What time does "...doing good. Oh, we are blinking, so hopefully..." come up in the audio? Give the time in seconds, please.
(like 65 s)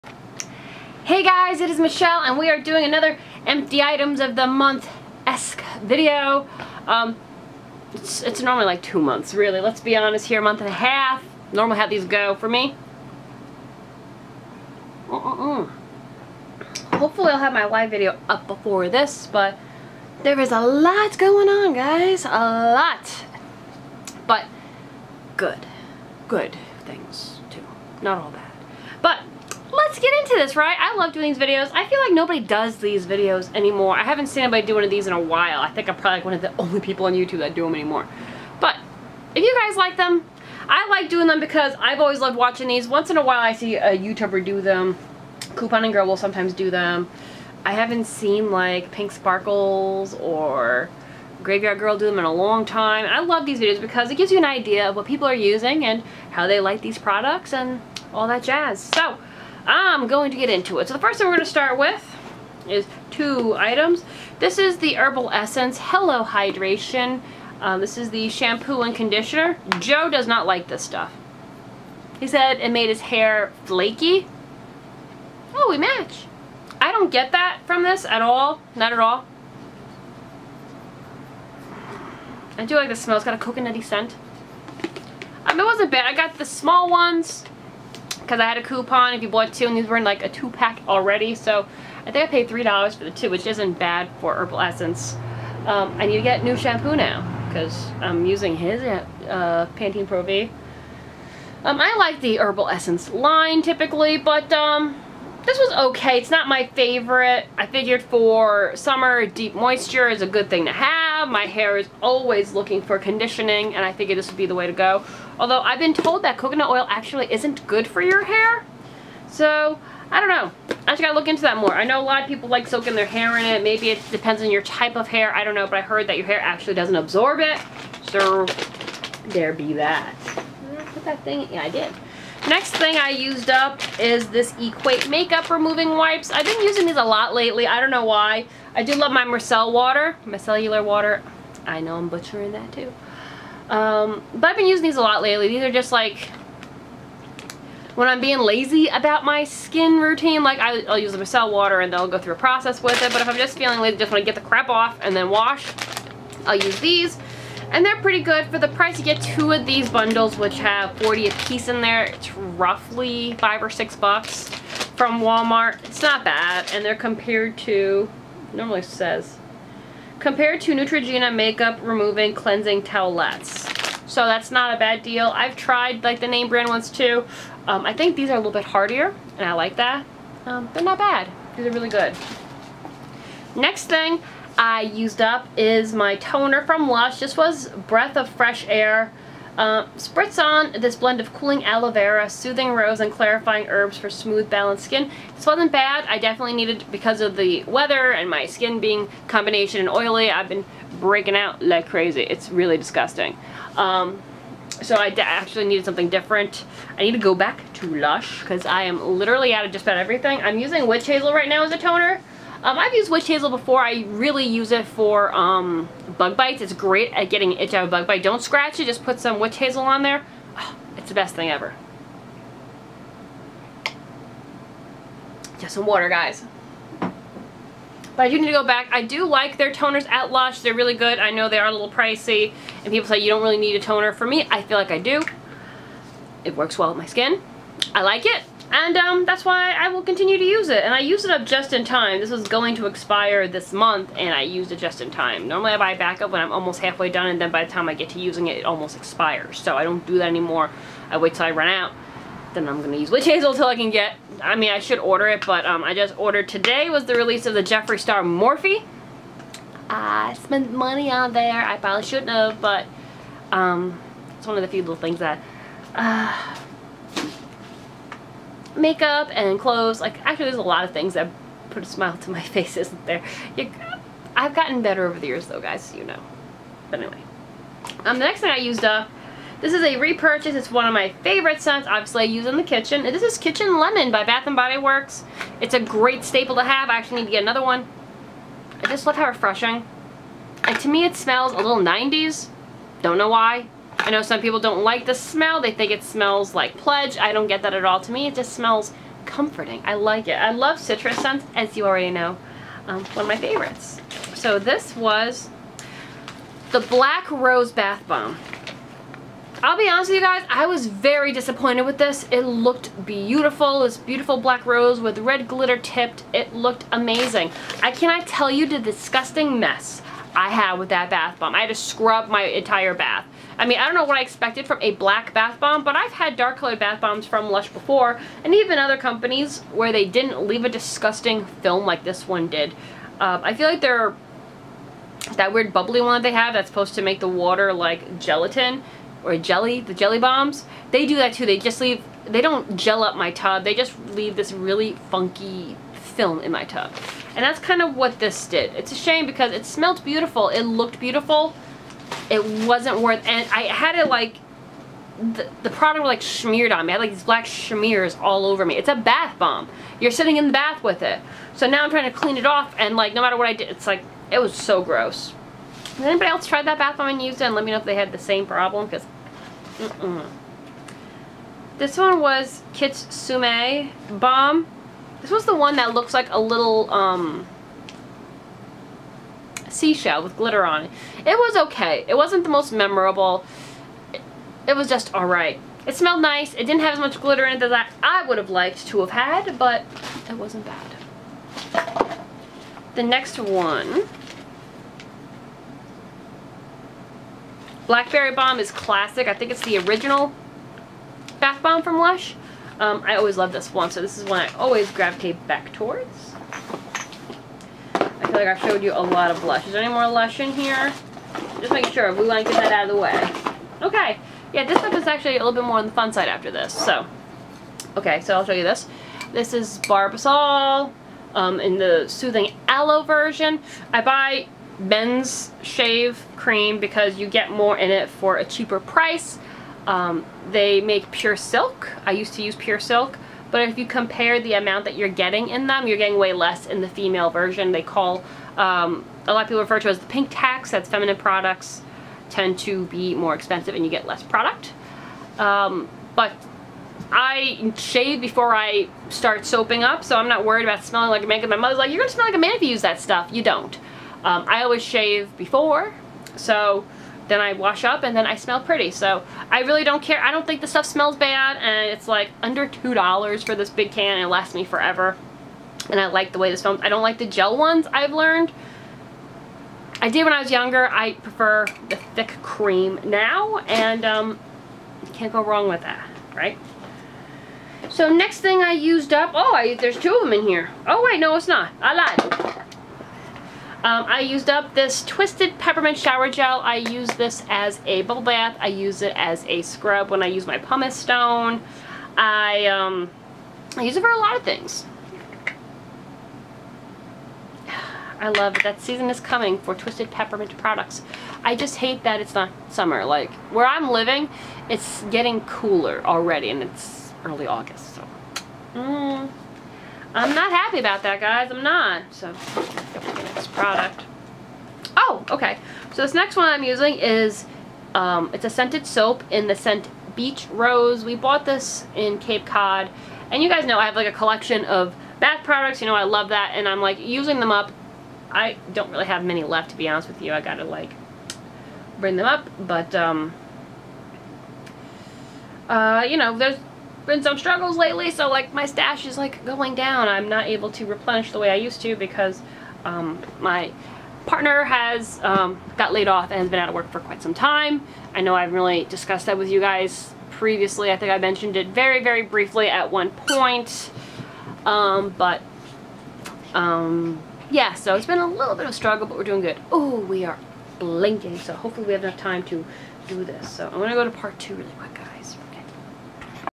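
559 s.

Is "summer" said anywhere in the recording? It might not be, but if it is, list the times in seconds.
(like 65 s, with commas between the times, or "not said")
108 s, 502 s.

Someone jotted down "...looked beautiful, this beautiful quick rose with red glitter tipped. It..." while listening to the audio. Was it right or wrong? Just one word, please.
wrong.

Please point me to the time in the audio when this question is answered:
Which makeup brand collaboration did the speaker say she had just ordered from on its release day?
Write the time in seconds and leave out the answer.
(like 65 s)
257 s.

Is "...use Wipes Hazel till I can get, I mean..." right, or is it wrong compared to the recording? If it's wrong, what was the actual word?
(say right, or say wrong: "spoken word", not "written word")
wrong: "Witch", not "Wipes".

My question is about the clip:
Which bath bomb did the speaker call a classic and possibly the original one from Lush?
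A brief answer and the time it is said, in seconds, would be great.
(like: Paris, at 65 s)
Blackberry Bomb, at 397 s.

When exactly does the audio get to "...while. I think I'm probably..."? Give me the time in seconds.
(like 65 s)
35 s.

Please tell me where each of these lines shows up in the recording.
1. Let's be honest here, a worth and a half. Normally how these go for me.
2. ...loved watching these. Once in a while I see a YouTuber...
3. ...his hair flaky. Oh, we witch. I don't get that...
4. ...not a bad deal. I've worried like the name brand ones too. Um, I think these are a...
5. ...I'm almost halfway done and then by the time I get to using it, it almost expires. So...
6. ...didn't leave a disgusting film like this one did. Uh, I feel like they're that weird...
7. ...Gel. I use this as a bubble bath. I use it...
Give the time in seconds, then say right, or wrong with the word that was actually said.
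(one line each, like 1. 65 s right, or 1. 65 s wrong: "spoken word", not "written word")
1. 9 s wrong: "month", not "worth"
2. 42 s right
3. 72 s wrong: "match", not "witch"
4. 174 s wrong: "tried", not "worried"
5. 246 s right
6. 330 s right
7. 486 s right.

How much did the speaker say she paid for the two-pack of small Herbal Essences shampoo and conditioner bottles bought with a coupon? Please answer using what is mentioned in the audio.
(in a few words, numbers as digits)
$3.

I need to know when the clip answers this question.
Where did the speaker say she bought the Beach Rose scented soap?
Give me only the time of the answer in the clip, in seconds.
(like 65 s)
522 s.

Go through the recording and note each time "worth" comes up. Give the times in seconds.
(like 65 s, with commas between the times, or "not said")
353 s.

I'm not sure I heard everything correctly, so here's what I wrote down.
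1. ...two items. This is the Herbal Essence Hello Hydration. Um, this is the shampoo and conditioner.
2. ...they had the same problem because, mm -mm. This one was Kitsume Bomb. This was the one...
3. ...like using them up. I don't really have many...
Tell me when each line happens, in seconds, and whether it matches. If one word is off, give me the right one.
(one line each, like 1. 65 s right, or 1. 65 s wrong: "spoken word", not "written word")
1. 63 s right
2. 367 s right
3. 526 s right.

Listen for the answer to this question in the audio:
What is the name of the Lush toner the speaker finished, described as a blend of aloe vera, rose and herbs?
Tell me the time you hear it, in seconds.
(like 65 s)
187 s.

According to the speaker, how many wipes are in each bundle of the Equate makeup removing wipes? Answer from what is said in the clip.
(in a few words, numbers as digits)
40.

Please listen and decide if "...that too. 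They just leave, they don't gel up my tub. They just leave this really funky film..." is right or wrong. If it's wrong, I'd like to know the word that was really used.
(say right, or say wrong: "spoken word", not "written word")
right.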